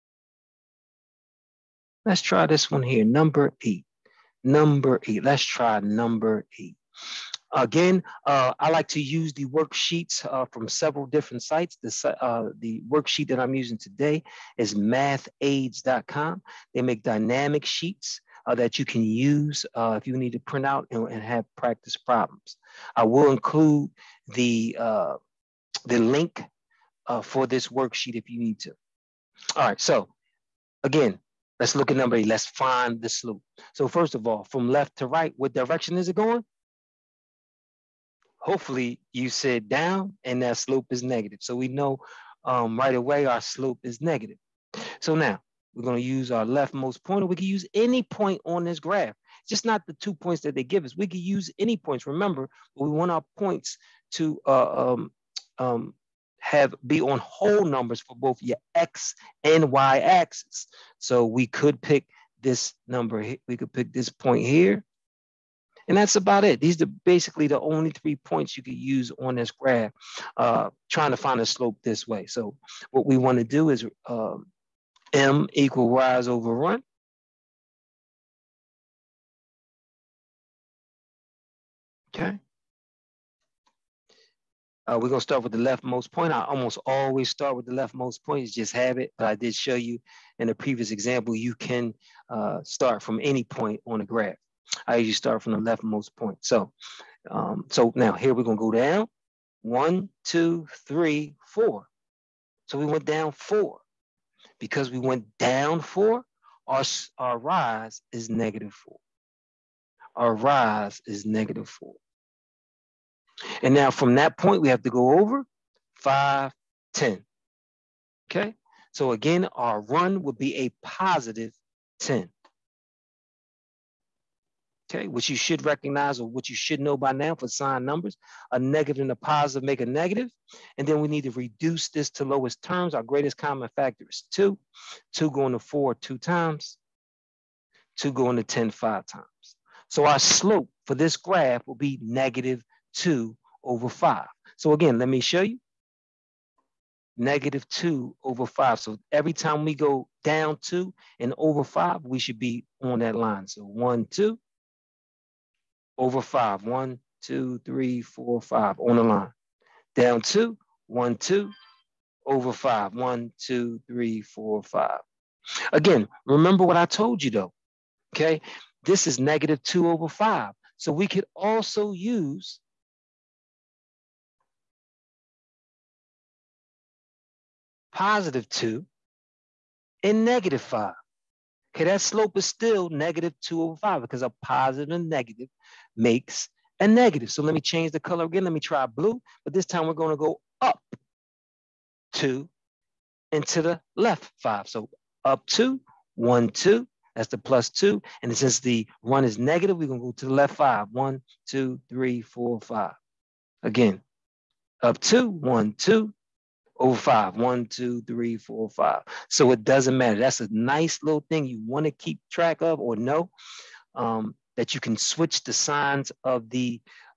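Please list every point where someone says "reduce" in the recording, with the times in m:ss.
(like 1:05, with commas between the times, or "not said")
2:11.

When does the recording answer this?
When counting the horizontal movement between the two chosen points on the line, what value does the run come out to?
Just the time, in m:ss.
2:00.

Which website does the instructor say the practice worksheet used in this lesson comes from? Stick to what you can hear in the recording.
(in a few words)
mathaids.com.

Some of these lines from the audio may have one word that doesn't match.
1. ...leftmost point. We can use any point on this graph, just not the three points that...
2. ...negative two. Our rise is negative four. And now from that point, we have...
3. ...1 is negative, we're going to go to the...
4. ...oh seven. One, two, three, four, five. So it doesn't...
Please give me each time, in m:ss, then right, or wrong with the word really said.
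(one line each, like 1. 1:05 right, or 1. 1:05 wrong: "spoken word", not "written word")
1. 0:46 wrong: "two", not "three"
2. 1:48 wrong: "four", not "two"
3. 3:19 right
4. 3:26 wrong: "five", not "seven".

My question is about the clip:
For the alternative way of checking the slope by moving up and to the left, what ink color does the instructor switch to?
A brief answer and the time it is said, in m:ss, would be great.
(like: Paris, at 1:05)
blue, at 3:08.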